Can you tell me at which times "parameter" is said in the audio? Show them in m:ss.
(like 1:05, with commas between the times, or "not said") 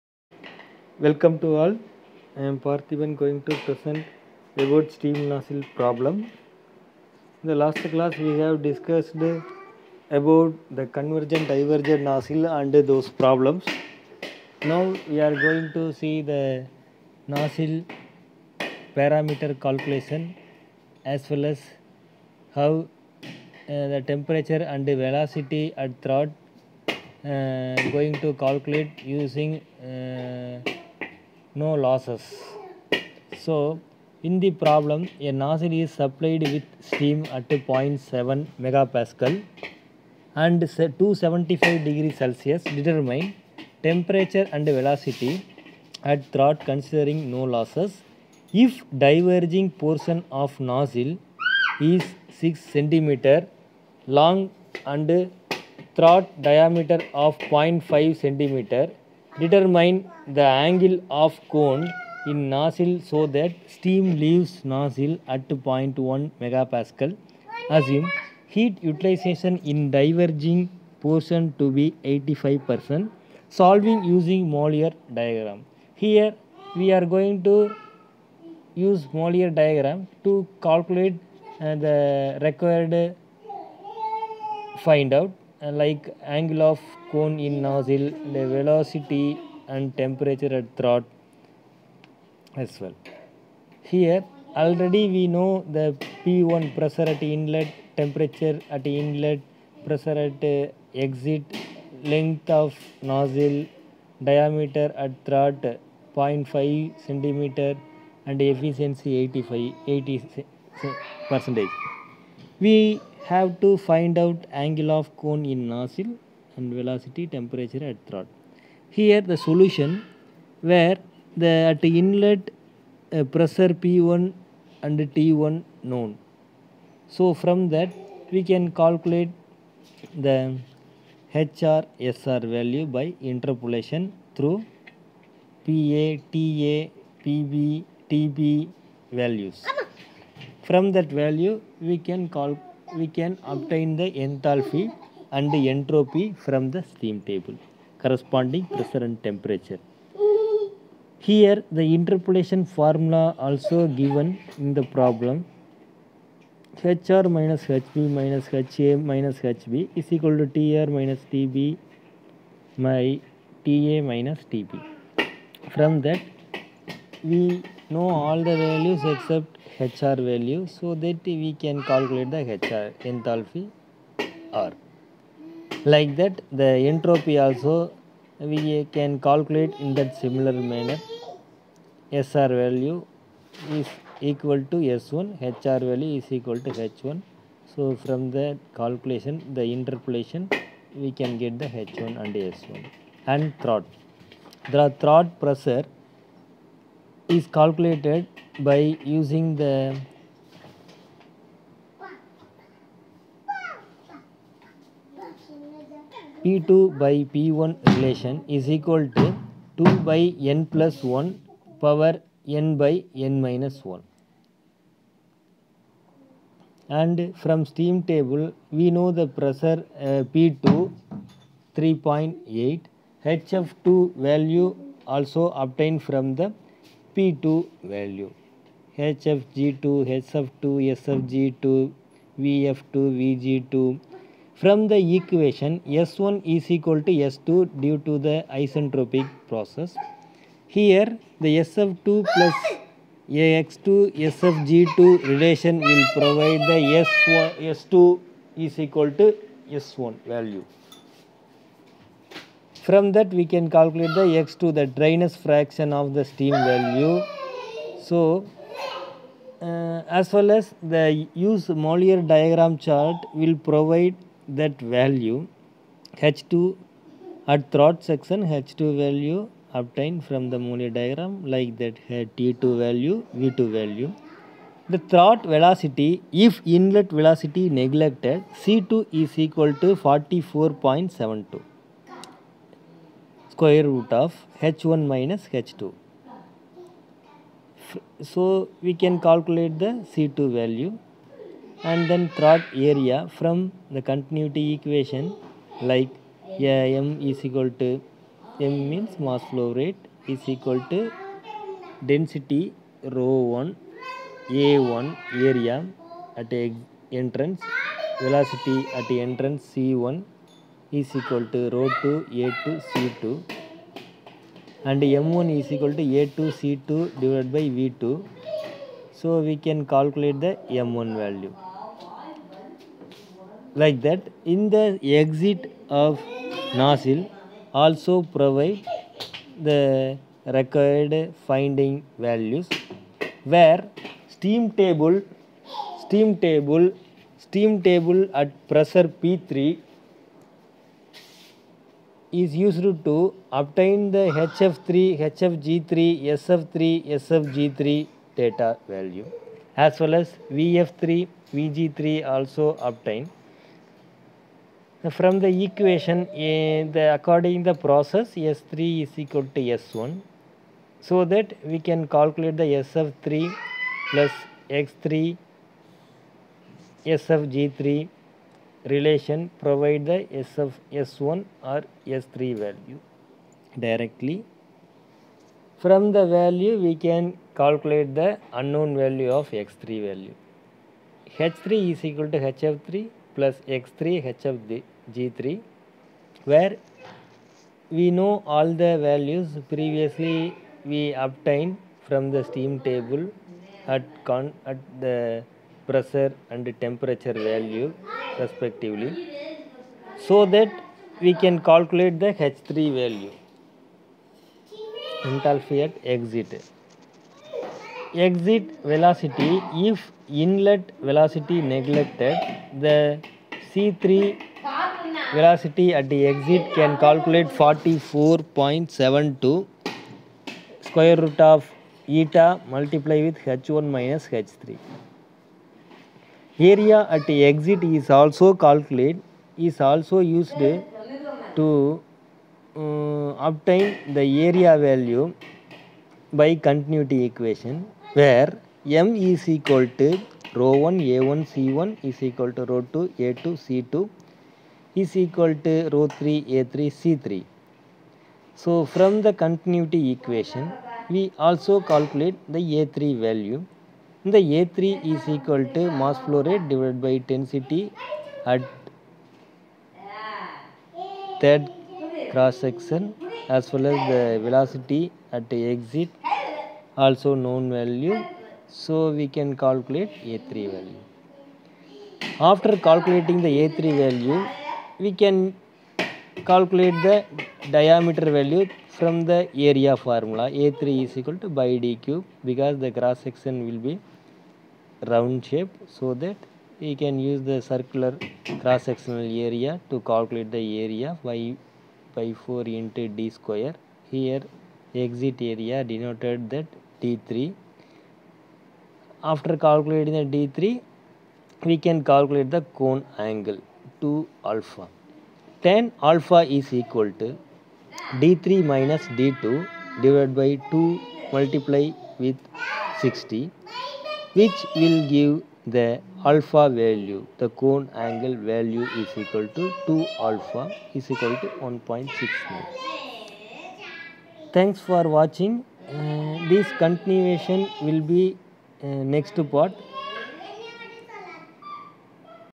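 0:18.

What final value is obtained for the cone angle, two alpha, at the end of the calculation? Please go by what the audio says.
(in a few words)
1.69.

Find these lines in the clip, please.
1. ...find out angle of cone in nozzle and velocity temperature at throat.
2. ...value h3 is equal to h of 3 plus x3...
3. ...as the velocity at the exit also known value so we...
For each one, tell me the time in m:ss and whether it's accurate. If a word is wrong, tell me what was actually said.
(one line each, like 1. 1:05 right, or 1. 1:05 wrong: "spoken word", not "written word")
1. 1:53 right
2. 6:20 right
3. 7:43 right.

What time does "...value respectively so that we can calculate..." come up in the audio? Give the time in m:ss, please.
6:37.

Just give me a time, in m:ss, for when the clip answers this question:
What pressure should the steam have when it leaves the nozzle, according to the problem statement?
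1:05.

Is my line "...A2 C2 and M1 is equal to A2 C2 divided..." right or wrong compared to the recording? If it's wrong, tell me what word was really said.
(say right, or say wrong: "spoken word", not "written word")
right.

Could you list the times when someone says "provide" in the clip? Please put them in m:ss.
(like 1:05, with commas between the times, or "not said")
4:06, 4:23, 5:28, 6:09.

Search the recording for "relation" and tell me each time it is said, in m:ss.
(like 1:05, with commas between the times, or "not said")
3:27, 4:05, 6:08.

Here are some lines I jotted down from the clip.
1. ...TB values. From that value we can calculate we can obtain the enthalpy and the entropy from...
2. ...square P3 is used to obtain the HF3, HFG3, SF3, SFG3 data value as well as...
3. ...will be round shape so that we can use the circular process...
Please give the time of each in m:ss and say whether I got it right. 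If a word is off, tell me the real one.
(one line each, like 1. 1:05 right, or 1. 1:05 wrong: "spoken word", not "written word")
1. 2:18 right
2. 5:38 wrong: "pressure", not "square"
3. 8:03 wrong: "cross", not "process".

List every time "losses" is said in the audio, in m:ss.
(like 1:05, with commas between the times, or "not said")
0:31, 0:47.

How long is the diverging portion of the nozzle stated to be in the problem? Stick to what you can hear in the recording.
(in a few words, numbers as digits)
6 centimeters.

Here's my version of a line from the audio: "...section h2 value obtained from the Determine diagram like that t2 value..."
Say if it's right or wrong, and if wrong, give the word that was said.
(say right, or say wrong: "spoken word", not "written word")
wrong: "Mollier", not "Determine".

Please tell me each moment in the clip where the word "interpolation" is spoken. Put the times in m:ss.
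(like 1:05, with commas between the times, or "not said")
2:13, 2:31, 3:09.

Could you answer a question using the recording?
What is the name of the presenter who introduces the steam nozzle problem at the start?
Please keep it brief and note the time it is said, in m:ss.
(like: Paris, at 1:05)
Parthiban, at 0:02.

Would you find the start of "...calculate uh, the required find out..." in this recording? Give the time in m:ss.
1:20.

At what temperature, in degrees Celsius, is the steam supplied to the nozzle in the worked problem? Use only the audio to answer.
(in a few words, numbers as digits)
275 degrees Celsius.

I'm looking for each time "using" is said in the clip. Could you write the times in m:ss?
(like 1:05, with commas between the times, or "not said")
0:29, 1:14, 3:19.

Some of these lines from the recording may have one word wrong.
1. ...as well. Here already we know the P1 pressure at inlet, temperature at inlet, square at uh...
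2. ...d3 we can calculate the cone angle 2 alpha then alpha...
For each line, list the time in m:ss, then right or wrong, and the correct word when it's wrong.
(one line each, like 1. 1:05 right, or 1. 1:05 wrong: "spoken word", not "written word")
1. 1:32 wrong: "pressure", not "square"
2. 8:20 right.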